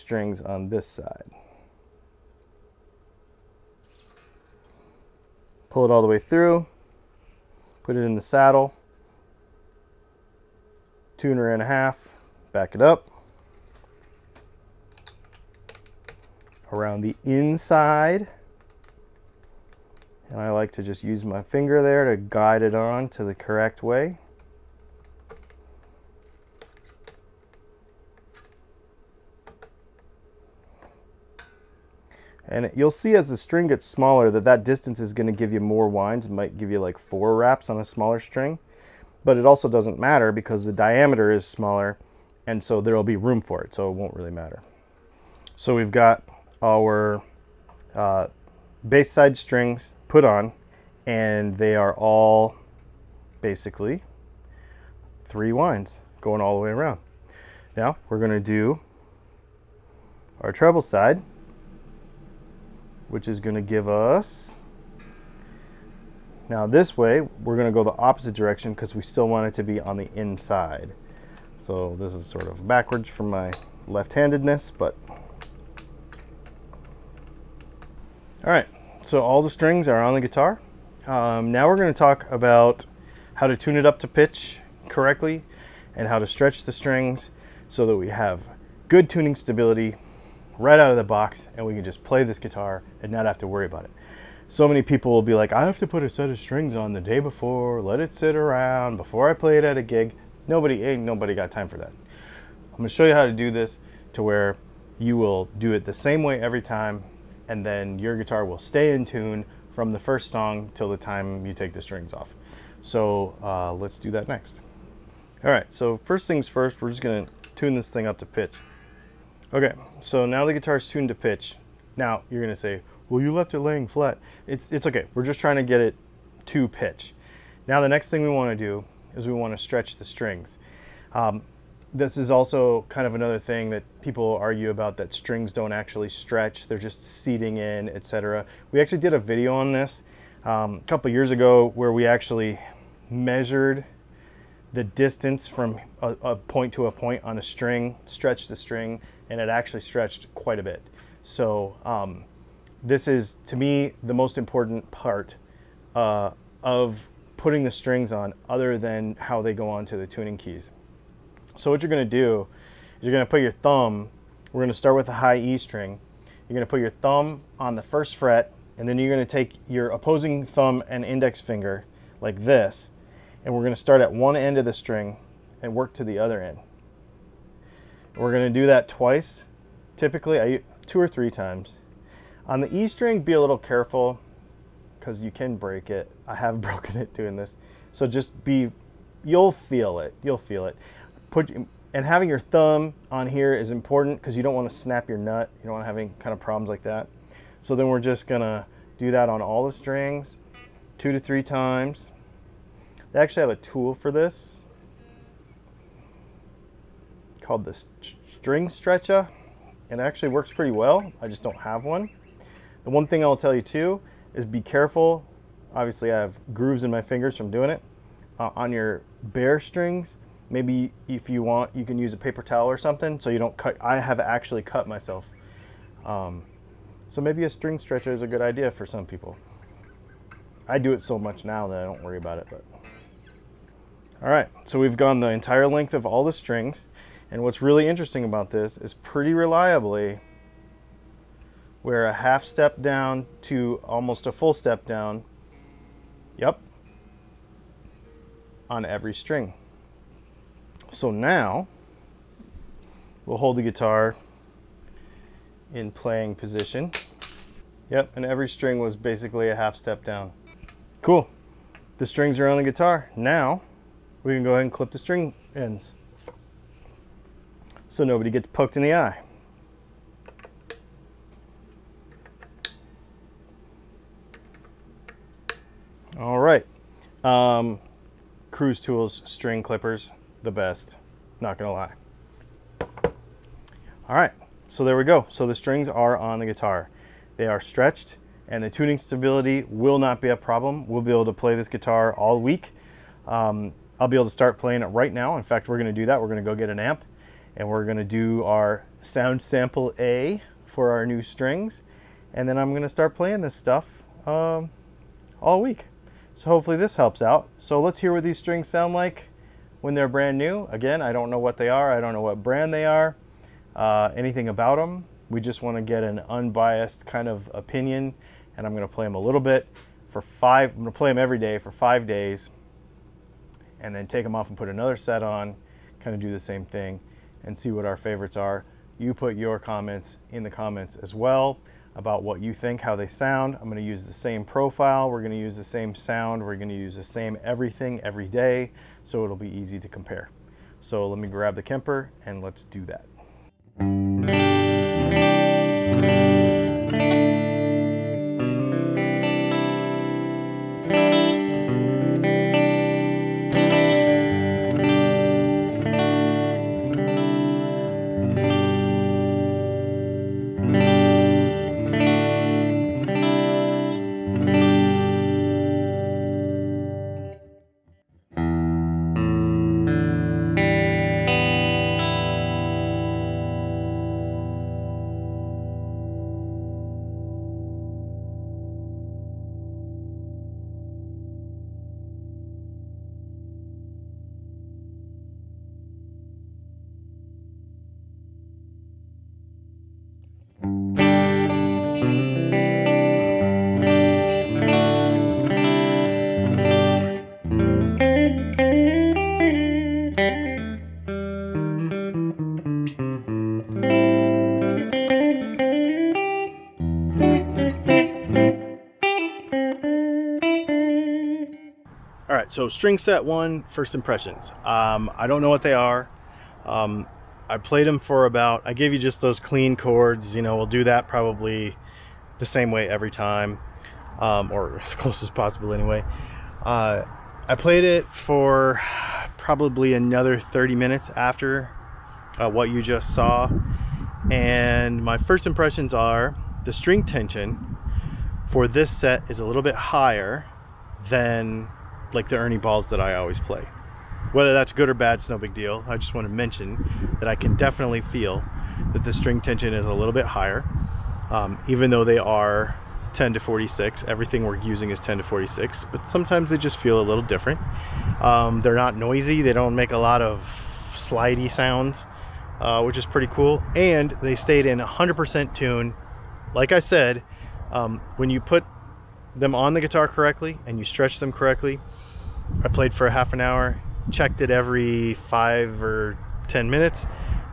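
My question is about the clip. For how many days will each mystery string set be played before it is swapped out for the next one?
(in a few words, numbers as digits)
5 days.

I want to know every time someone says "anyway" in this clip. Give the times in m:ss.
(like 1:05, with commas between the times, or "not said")
7:05.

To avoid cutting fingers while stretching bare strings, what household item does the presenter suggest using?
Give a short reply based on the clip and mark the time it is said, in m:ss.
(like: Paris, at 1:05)
paper towel, at 3:42.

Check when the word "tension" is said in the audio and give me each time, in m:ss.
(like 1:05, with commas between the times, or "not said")
7:17, 7:29.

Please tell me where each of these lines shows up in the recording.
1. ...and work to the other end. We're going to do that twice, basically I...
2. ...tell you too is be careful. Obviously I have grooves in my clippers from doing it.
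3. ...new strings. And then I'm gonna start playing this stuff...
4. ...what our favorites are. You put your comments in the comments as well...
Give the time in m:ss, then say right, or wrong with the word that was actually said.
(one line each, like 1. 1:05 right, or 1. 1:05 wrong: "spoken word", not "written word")
1. 2:55 wrong: "typically", not "basically"
2. 3:33 wrong: "fingers", not "clippers"
3. 5:01 right
4. 5:27 right.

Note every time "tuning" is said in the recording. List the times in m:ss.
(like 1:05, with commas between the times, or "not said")
1:29, 2:40, 4:48.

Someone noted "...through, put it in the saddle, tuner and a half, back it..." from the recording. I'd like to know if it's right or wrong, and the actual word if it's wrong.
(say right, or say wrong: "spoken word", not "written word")
right.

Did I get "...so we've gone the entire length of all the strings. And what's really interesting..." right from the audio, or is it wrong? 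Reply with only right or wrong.
right.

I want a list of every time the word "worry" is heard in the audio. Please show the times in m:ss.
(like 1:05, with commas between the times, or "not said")
1:33, 3:52.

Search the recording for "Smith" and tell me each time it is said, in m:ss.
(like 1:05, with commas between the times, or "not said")
not said.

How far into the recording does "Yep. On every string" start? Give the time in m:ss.
4:06.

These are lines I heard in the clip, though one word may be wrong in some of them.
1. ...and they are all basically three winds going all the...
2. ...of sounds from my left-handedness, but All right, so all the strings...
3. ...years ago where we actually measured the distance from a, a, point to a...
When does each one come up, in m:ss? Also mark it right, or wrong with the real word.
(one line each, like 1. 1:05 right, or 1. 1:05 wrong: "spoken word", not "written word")
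1. 0:51 right
2. 1:12 wrong: "backwards", not "sounds"
3. 2:21 right.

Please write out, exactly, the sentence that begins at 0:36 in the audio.
It might give you like four wraps on a smaller string.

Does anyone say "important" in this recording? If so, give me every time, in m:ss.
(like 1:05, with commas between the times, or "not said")
2:34, 3:13.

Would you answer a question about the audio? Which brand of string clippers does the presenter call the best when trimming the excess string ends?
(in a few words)
Cruz Tools.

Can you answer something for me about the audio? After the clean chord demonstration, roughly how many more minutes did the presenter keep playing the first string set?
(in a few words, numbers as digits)
30 minutes.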